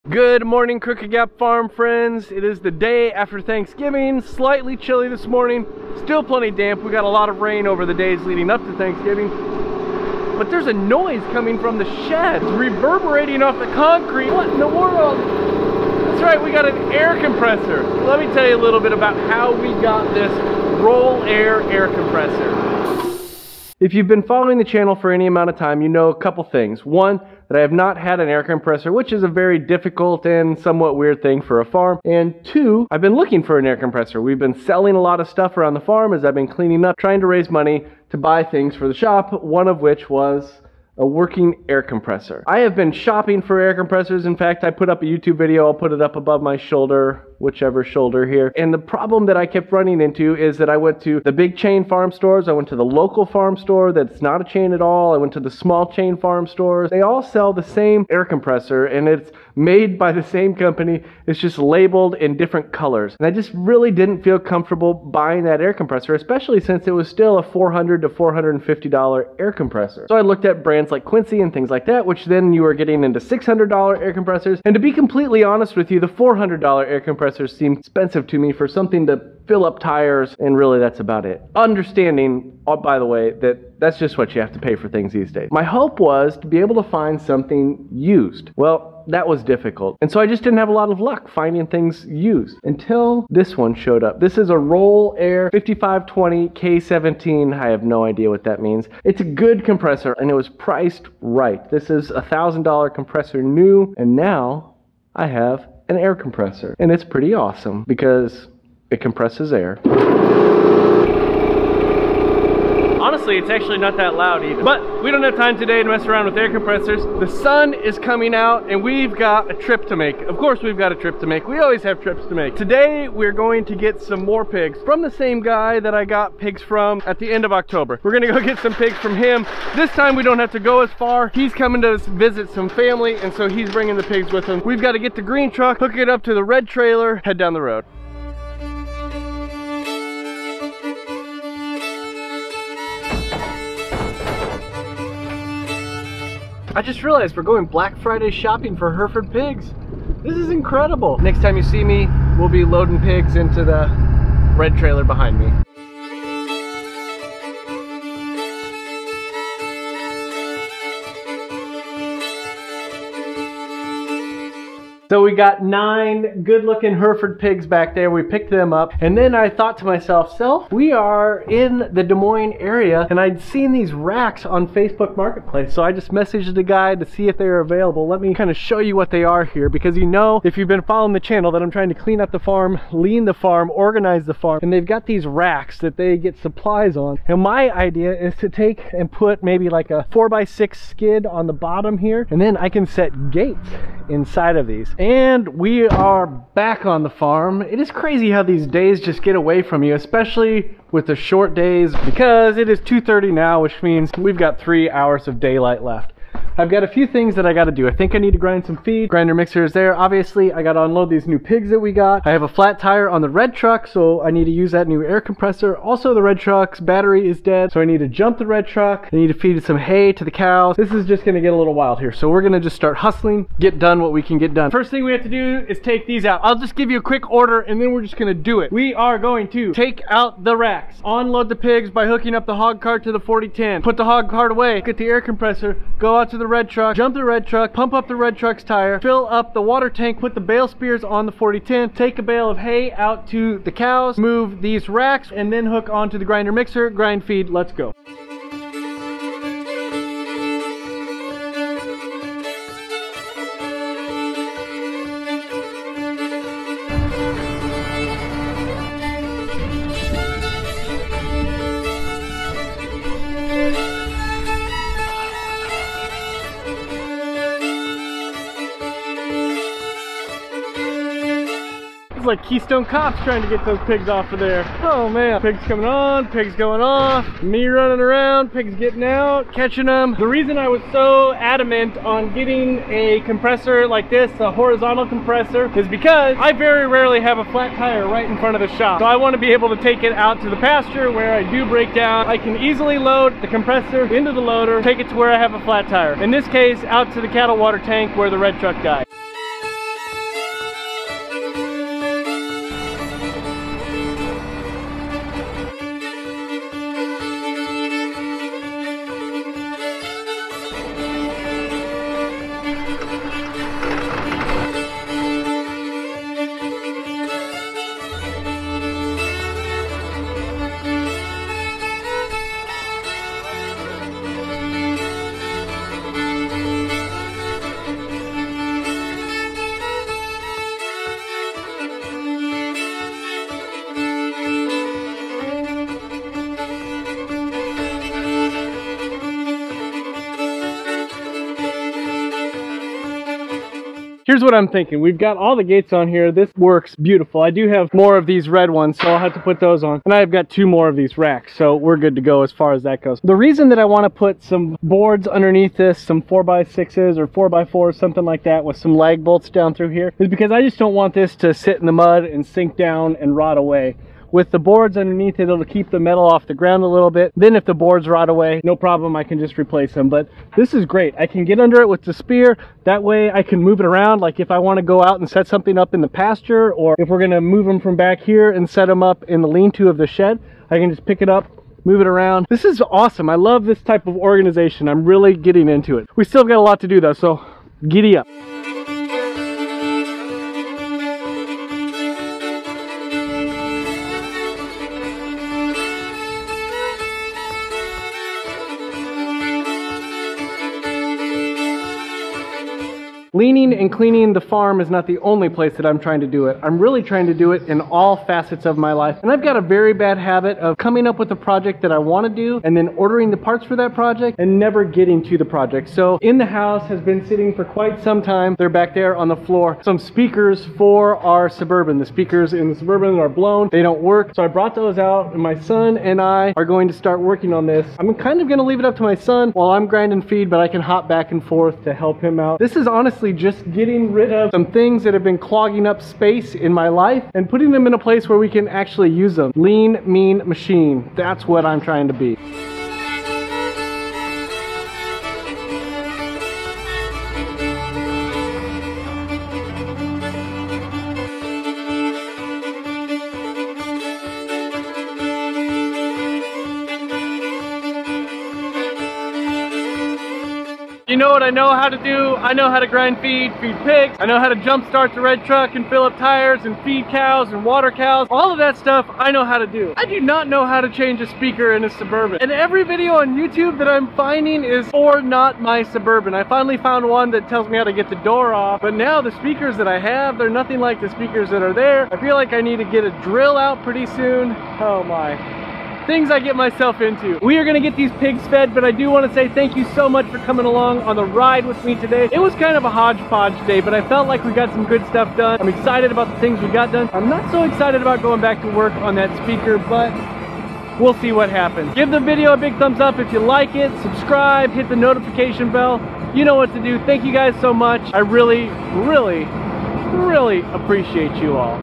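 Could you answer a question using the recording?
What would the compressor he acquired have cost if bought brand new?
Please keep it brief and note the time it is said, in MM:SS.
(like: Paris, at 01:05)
$1,000, at 01:42.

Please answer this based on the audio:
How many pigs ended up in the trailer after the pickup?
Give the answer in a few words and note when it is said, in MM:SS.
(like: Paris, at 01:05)
9, at 02:45.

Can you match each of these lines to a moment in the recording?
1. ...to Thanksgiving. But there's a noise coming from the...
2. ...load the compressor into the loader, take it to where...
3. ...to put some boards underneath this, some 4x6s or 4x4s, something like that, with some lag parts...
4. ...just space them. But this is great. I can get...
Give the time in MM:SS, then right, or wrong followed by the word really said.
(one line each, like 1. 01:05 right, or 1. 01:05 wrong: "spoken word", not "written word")
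1. 00:08 right
2. 04:52 right
3. 05:54 wrong: "bolts", not "parts"
4. 06:09 wrong: "replace", not "space".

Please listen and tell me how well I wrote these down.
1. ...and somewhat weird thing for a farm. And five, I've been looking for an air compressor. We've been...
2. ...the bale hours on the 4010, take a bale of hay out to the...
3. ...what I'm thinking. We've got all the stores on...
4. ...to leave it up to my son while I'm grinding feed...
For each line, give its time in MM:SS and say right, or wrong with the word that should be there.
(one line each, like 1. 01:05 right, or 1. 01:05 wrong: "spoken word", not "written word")
1. 00:30 wrong: "two", not "five"
2. 04:00 wrong: "spears", not "hours"
3. 05:44 wrong: "gates", not "stores"
4. 07:08 right.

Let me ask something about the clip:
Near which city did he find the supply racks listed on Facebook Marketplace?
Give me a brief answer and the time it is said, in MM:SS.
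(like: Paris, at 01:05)
Des Moines, at 02:52.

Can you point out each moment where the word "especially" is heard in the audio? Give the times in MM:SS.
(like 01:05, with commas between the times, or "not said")
01:06, 03:19.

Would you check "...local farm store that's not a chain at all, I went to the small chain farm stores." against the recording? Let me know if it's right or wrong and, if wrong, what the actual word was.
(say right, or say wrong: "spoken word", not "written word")
right.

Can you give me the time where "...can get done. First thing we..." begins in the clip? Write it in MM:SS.
03:44.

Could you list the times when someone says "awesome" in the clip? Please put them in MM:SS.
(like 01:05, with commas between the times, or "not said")
01:47, 06:22.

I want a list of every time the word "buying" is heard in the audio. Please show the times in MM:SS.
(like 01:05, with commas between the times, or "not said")
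01:04.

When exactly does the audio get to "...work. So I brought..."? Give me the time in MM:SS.
07:04.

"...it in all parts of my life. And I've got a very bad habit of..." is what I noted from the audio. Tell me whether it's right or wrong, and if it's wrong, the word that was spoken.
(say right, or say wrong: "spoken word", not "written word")
wrong: "facets", not "parts".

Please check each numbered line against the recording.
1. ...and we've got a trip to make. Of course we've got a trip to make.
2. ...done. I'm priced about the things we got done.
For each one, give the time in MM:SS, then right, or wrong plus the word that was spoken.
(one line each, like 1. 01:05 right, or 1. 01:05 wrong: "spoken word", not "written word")
1. 01:58 right
2. 08:15 wrong: "excited", not "priced".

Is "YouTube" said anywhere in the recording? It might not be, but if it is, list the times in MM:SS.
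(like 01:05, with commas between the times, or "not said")
00:45, 07:53.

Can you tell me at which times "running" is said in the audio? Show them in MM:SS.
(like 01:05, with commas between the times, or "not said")
00:49, 04:37.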